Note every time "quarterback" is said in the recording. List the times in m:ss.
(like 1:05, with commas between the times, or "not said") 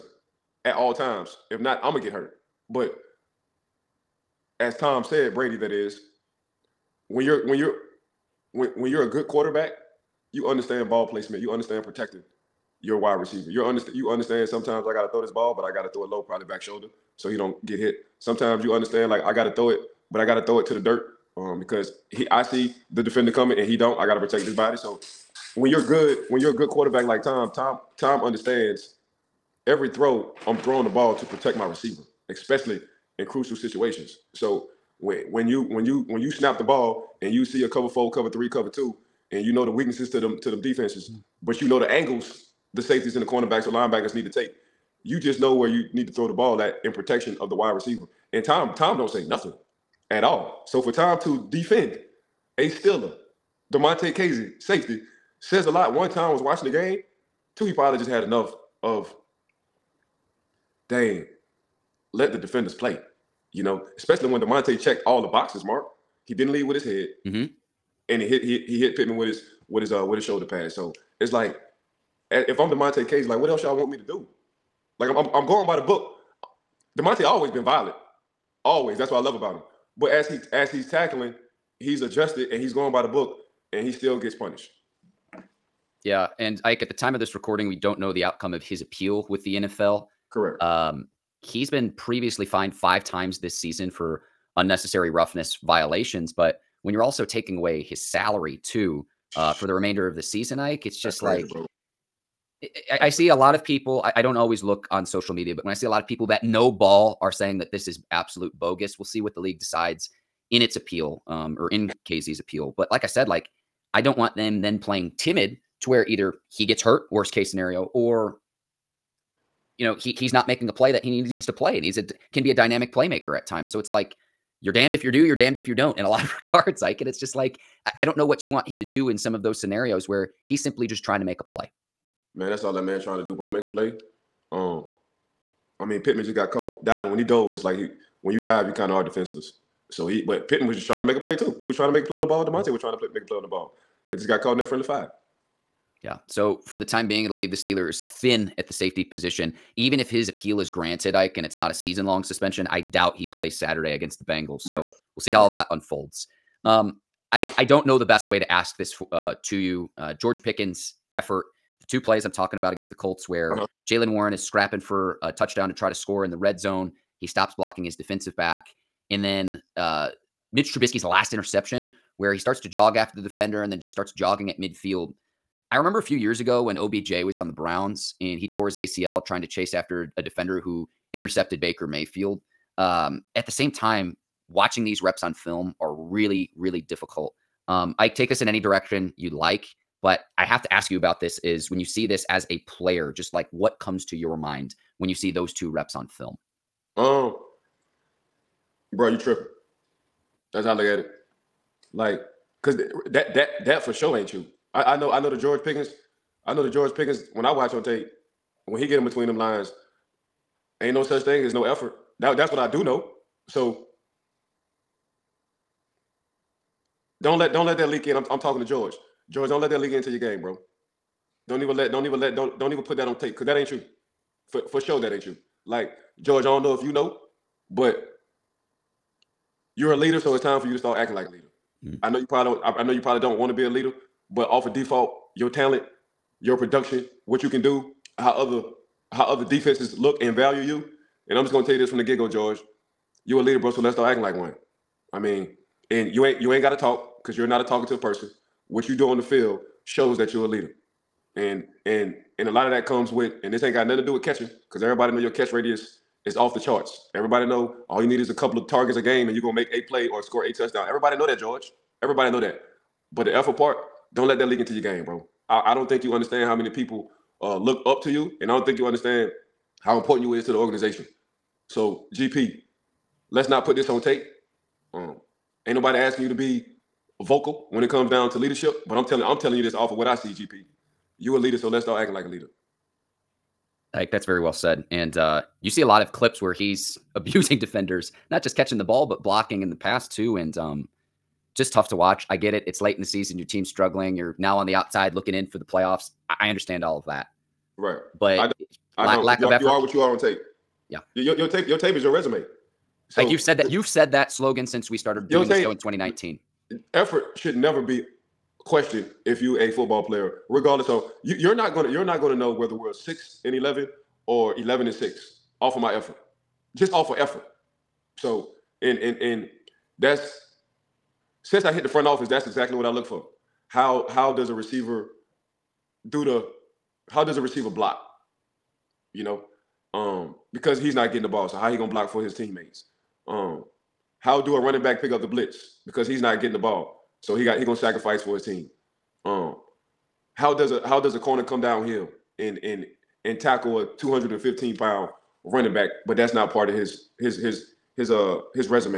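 0:09, 0:26.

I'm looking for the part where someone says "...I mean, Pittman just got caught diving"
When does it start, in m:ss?
2:15.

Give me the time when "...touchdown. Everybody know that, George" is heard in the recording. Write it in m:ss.
4:20.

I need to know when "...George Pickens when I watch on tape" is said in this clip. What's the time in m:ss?
3:26.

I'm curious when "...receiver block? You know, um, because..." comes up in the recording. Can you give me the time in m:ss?
5:27.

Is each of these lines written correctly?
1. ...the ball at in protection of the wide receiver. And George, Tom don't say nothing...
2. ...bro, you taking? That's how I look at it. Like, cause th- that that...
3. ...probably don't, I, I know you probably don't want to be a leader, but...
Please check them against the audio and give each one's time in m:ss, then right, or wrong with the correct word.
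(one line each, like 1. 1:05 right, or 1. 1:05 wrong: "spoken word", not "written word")
1. 0:46 wrong: "Tom", not "George"
2. 3:18 wrong: "tripping", not "taking"
3. 3:52 right.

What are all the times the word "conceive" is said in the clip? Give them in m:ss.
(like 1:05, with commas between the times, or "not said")
not said.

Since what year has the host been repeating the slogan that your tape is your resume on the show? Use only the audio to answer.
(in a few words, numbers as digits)
2019.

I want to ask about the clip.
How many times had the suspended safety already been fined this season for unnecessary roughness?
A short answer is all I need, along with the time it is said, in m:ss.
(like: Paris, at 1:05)
5, at 1:32.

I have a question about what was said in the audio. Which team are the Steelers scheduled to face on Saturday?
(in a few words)
Bengals.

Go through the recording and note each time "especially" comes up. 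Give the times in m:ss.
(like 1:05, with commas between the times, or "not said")
0:32, 1:03.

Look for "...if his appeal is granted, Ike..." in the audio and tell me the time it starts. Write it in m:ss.
2:29.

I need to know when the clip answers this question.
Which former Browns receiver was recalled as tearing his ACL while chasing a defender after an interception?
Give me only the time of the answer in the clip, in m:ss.
2:56.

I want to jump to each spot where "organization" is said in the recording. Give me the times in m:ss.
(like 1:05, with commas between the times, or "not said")
4:30.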